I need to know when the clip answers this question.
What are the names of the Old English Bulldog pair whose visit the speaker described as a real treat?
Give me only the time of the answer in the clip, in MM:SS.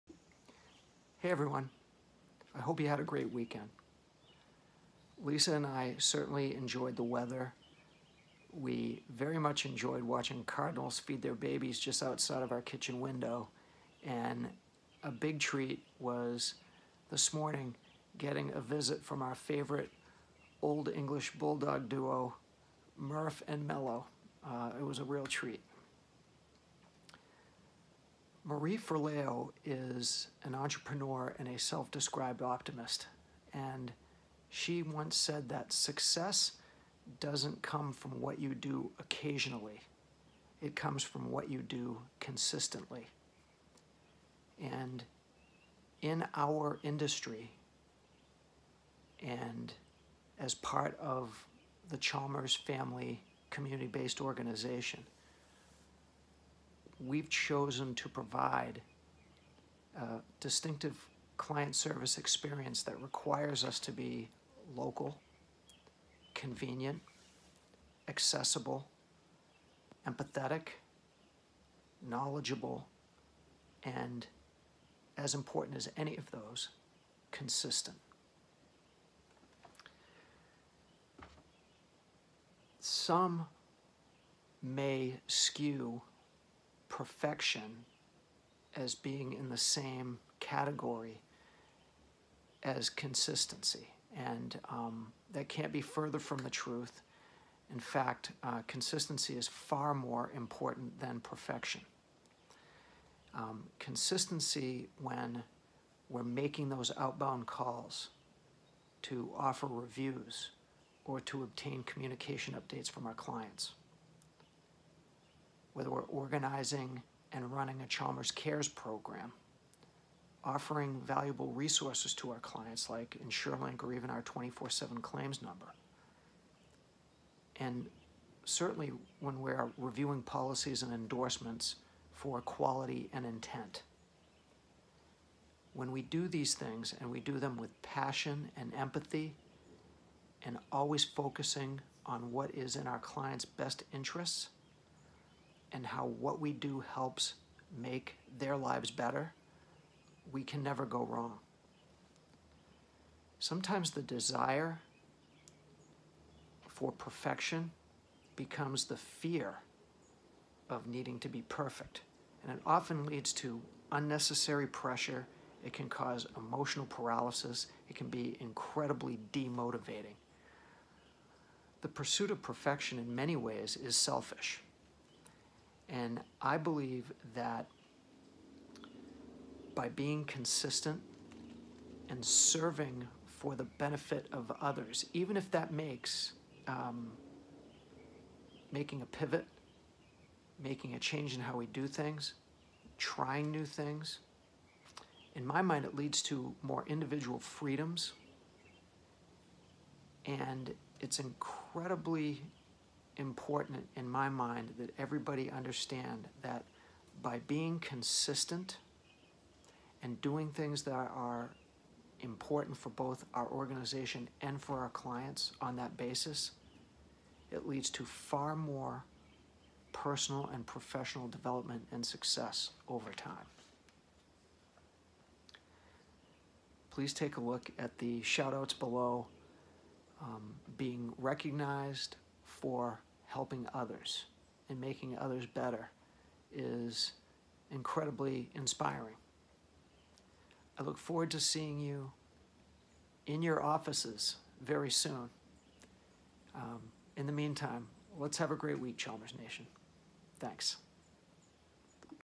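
00:22.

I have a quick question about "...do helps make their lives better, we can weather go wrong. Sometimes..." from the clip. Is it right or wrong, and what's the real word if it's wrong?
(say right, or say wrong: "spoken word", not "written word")
wrong: "never", not "weather".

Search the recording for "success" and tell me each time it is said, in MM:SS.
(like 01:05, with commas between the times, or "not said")
00:35, 03:42.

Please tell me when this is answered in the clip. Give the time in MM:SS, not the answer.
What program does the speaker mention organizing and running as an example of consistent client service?
01:57.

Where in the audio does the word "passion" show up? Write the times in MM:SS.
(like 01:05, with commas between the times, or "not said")
02:17.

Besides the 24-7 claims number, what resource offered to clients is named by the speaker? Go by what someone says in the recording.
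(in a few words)
InsureLink.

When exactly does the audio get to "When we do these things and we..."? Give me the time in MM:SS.
02:15.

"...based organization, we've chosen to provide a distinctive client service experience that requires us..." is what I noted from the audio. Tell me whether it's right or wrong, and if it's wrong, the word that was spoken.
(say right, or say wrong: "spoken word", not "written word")
right.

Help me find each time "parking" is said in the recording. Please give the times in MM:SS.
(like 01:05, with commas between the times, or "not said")
not said.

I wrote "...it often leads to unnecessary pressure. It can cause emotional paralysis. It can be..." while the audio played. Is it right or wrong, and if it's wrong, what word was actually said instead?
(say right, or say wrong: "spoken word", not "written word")
right.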